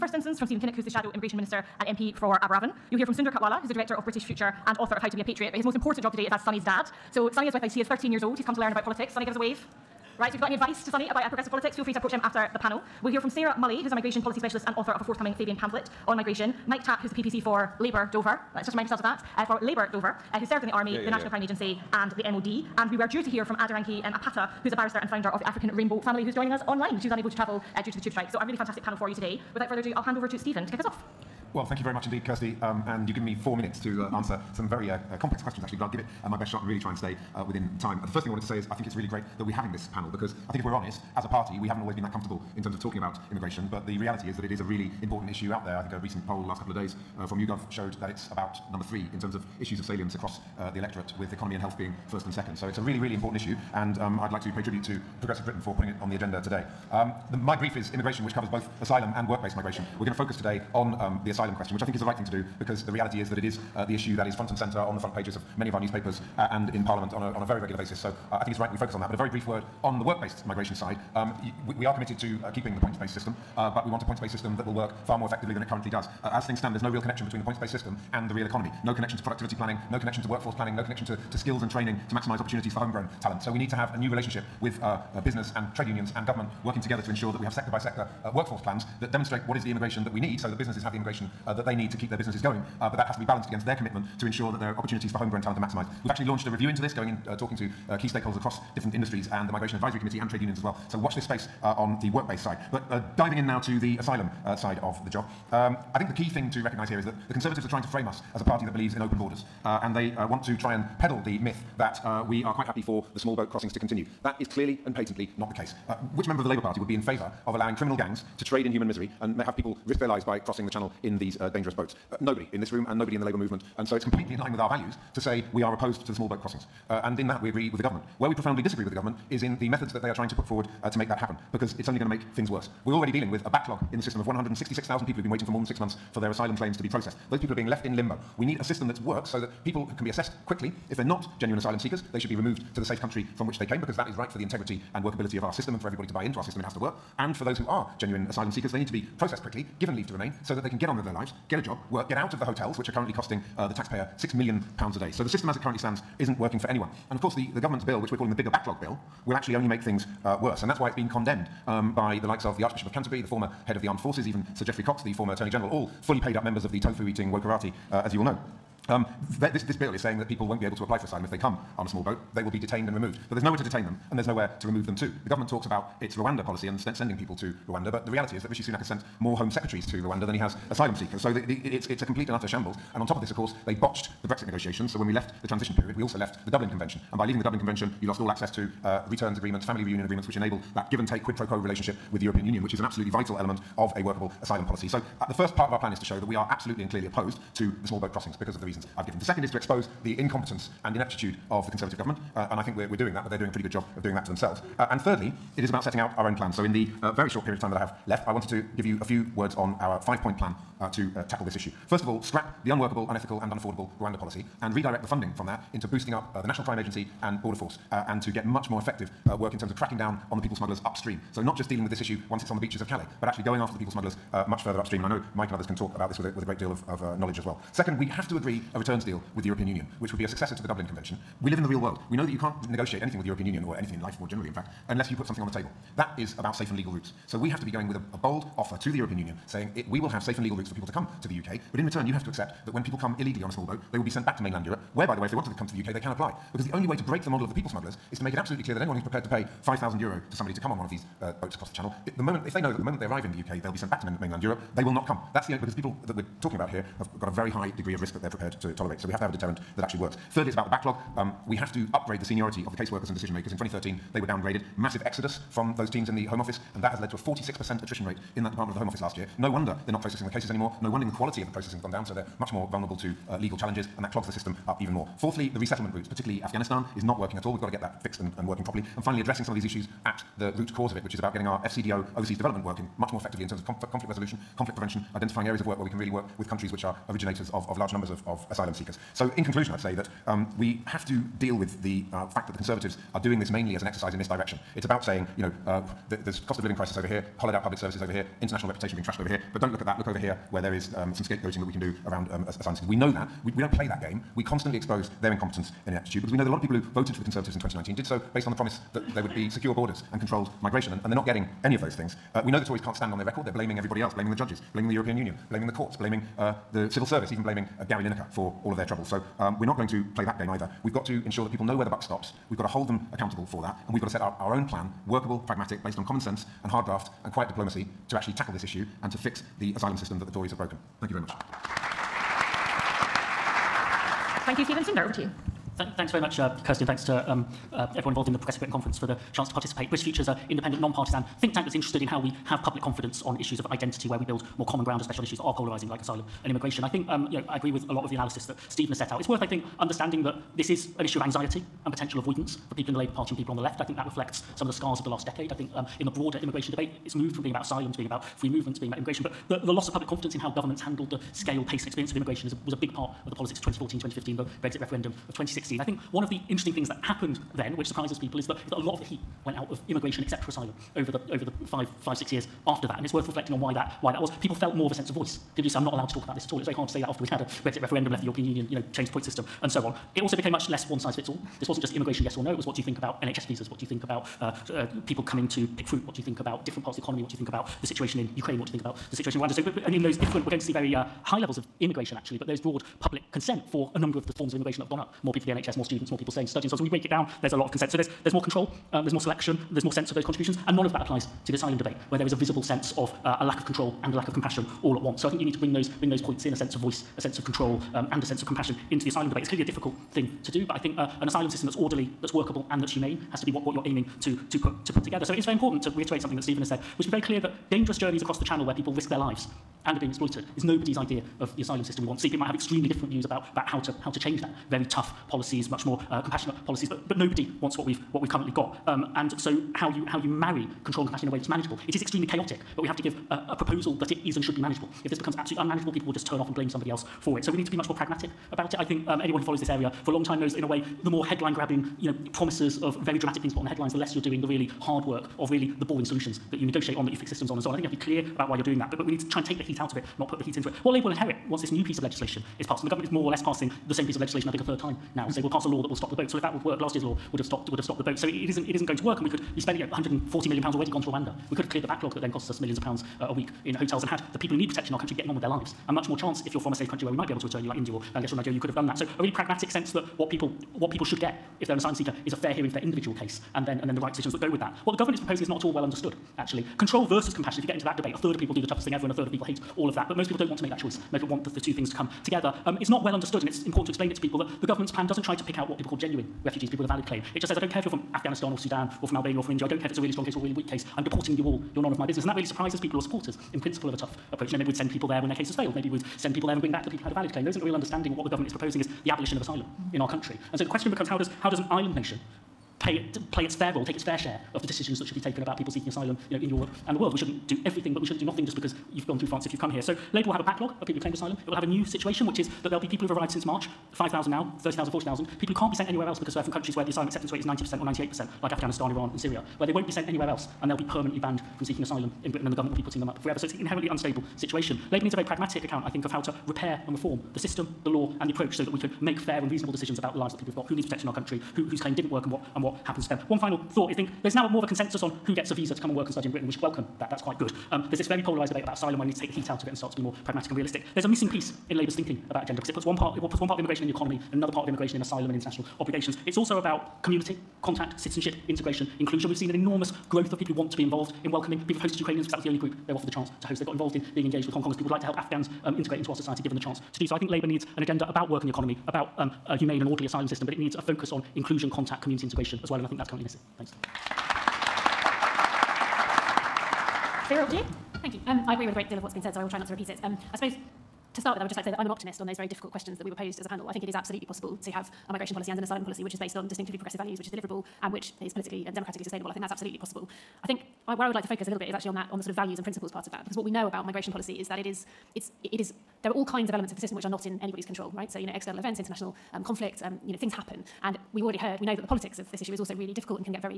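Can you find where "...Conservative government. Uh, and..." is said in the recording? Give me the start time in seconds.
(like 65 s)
201 s.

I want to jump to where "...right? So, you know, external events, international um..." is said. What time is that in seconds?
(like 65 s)
587 s.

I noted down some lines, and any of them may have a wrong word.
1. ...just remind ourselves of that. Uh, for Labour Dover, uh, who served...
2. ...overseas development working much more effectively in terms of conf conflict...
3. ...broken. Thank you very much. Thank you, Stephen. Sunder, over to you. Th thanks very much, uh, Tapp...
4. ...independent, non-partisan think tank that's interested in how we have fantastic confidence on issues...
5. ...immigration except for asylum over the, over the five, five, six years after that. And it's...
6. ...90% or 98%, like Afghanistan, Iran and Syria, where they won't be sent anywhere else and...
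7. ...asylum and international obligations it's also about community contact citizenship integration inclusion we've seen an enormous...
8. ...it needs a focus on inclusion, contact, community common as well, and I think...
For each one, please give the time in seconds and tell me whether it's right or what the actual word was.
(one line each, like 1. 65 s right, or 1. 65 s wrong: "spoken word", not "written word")
1. 18 s right
2. 282 s right
3. 330 s wrong: "Kirsty", not "Tapp"
4. 340 s wrong: "public", not "fantastic"
5. 369 s right
6. 517 s right
7. 545 s right
8. 560 s wrong: "integration", not "common".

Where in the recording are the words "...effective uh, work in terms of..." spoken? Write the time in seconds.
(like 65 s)
218 s.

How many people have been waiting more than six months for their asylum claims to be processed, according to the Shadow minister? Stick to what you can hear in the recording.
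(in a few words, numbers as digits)
166,000.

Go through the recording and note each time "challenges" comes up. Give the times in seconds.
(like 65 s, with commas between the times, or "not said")
273 s.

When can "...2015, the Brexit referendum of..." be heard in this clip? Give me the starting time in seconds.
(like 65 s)
363 s.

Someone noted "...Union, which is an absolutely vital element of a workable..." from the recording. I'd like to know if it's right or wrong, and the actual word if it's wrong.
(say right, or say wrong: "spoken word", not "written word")
right.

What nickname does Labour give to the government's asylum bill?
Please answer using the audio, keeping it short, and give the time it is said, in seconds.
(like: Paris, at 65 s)
the bigger backlog bill, at 158 s.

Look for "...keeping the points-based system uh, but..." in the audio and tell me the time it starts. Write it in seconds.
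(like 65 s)
72 s.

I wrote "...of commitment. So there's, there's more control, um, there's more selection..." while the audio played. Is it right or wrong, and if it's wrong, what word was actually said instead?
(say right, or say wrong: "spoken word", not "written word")
wrong: "consent", not "commitment".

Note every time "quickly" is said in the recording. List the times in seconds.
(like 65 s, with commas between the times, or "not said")
140 s, 149 s.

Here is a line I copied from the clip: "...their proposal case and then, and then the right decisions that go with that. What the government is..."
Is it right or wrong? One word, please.
wrong.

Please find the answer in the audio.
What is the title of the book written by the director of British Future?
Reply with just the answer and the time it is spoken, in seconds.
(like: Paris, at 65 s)
How to Be a Patriot, at 5 s.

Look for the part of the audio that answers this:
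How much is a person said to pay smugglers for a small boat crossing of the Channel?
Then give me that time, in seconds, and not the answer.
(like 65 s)
249 s.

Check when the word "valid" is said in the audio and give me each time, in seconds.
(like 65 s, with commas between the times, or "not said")
486 s, 497 s.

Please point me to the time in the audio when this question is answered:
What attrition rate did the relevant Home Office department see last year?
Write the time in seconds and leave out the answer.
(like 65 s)
267 s.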